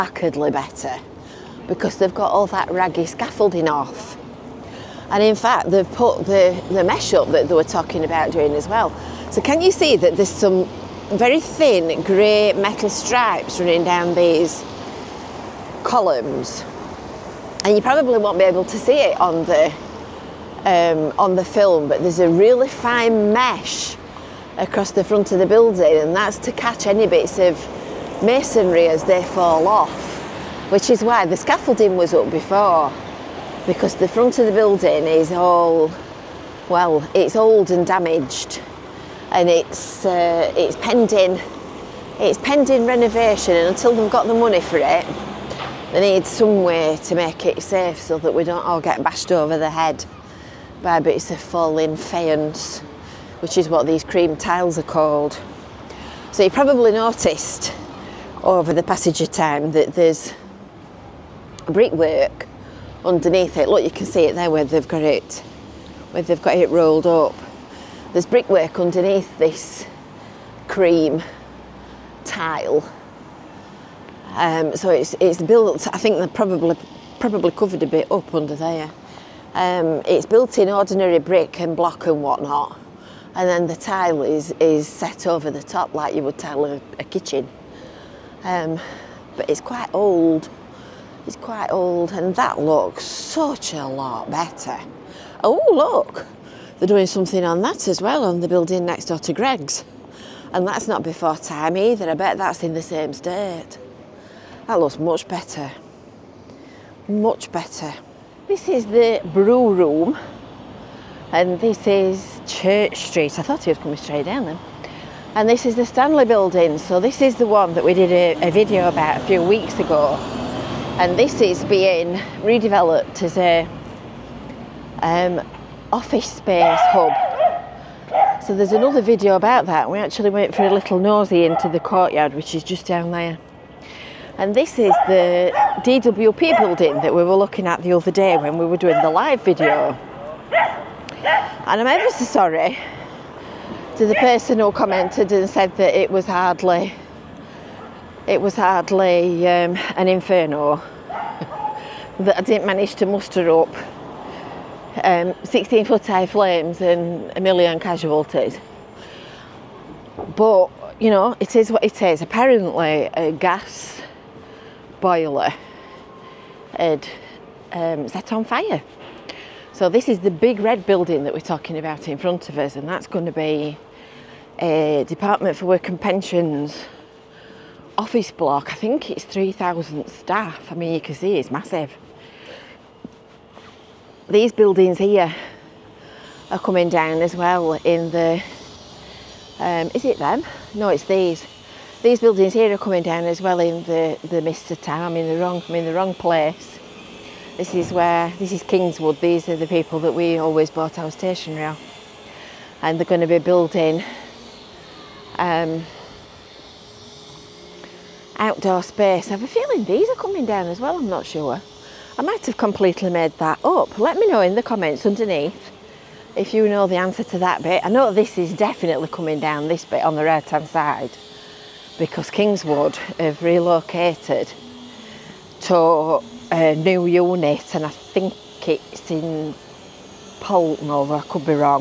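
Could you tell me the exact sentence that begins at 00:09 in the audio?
So can you see that there's some very thin grey metal stripes running down these columns?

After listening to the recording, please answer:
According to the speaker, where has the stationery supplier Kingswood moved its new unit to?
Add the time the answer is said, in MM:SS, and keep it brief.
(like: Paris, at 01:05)
Poulton Over, at 03:50.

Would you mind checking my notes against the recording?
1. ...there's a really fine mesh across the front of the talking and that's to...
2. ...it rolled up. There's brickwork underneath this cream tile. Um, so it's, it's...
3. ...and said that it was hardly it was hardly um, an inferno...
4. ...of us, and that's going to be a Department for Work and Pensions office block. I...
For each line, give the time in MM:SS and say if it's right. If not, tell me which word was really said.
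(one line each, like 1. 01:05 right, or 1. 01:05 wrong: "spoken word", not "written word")
1. 00:22 wrong: "building", not "talking"
2. 01:06 right
3. 02:25 right
4. 02:52 right.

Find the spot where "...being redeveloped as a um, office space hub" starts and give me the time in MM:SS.
02:01.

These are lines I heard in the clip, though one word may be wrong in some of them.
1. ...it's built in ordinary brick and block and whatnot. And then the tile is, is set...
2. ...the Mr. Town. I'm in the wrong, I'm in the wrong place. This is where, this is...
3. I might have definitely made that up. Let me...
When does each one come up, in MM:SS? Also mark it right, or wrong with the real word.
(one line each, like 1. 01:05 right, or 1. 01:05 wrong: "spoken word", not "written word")
1. 01:20 right
2. 03:14 right
3. 03:32 wrong: "completely", not "definitely".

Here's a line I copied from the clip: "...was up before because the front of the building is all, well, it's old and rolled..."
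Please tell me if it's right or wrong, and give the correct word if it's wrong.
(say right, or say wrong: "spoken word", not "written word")
wrong: "damaged", not "rolled".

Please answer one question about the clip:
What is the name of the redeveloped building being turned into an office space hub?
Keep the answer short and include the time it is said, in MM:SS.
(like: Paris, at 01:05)
the Stanley building, at 01:55.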